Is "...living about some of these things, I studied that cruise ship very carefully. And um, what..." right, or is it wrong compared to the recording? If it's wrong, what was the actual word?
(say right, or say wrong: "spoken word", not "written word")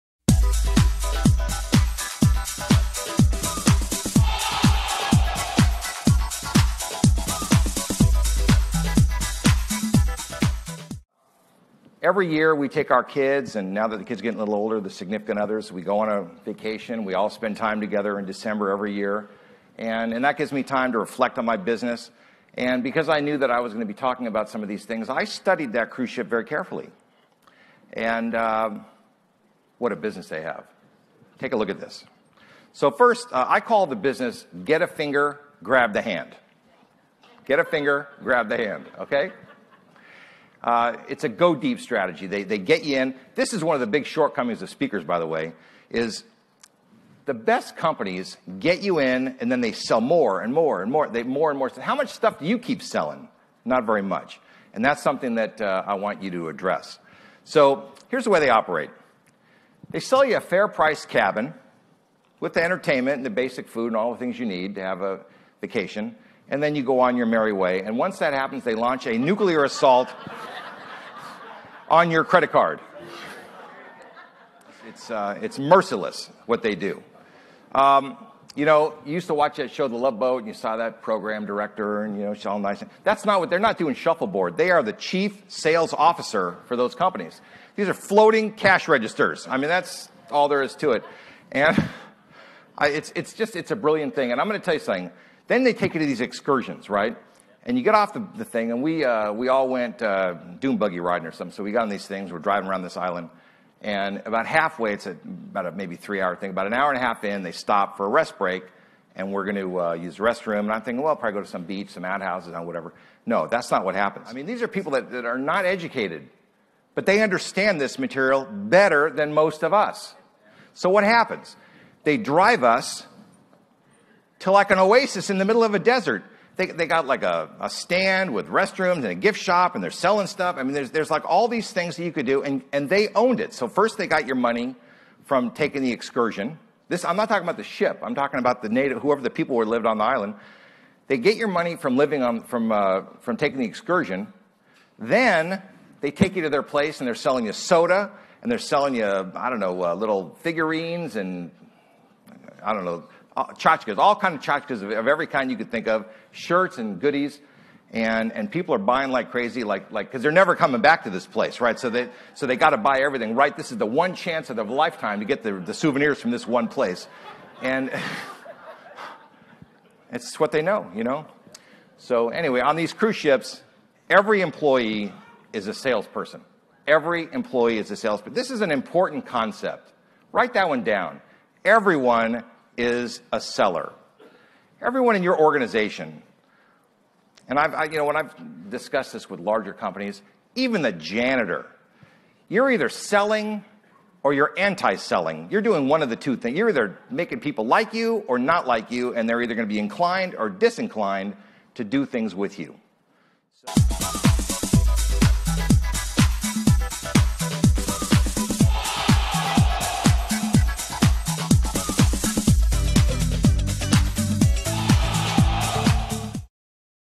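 wrong: "talking", not "living".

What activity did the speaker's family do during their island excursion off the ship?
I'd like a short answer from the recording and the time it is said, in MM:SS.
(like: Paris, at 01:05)
Dune buggy riding, at 01:40.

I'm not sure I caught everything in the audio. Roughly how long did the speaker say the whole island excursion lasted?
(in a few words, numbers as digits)
3 hours.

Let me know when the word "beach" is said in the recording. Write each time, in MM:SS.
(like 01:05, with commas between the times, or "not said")
01:51.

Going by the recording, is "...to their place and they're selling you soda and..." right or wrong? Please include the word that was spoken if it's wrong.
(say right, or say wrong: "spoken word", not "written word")
right.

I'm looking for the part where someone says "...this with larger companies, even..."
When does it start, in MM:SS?
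03:09.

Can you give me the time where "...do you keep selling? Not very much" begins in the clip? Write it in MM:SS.
00:52.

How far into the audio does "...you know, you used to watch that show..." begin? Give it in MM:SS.
01:18.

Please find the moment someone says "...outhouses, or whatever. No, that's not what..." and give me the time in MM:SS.
01:52.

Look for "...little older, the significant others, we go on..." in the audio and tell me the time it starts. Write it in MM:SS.
00:14.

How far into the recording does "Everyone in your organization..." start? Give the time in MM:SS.
03:04.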